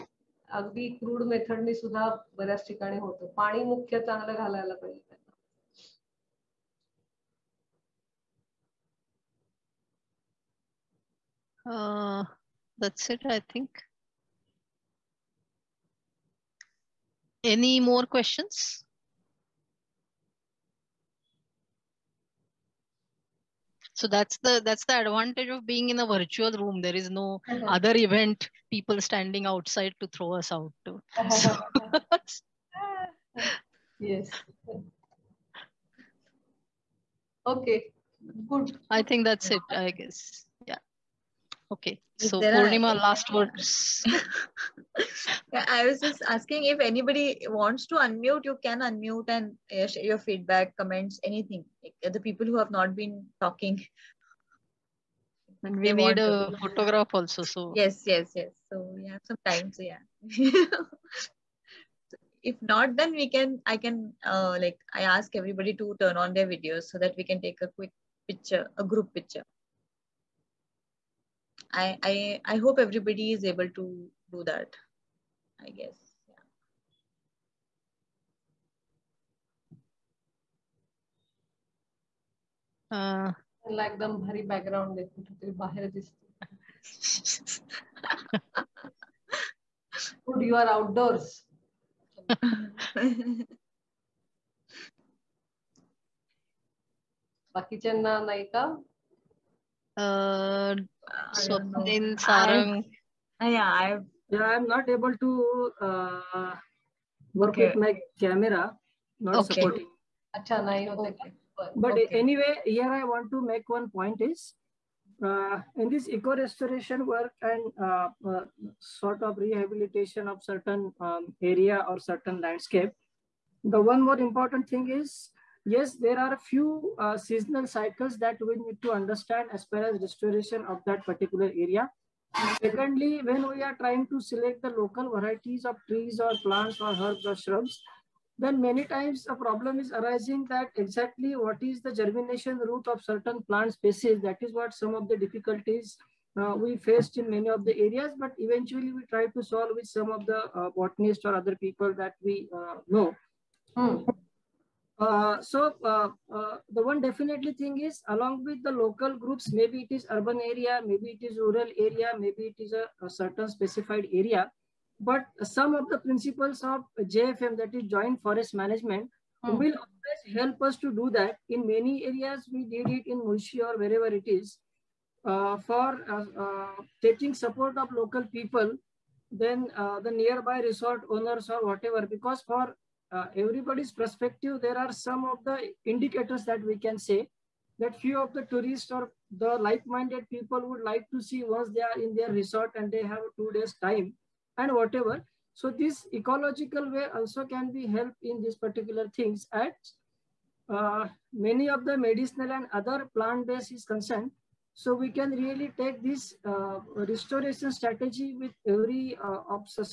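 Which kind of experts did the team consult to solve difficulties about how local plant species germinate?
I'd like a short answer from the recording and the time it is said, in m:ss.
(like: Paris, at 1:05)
botanists, at 2:30.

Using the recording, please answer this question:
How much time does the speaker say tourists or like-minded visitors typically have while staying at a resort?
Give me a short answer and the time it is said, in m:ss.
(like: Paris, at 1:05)
2 days, at 3:13.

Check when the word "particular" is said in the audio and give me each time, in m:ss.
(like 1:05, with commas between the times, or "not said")
2:11, 3:18.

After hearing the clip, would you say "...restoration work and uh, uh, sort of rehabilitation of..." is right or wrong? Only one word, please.
right.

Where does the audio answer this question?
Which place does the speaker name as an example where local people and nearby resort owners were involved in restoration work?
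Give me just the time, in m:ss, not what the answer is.
2:53.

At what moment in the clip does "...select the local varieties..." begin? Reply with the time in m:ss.
2:14.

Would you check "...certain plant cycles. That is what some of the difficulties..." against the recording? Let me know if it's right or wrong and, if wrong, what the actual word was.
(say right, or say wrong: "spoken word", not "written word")
wrong: "species", not "cycles".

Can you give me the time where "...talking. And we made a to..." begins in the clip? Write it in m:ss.
0:53.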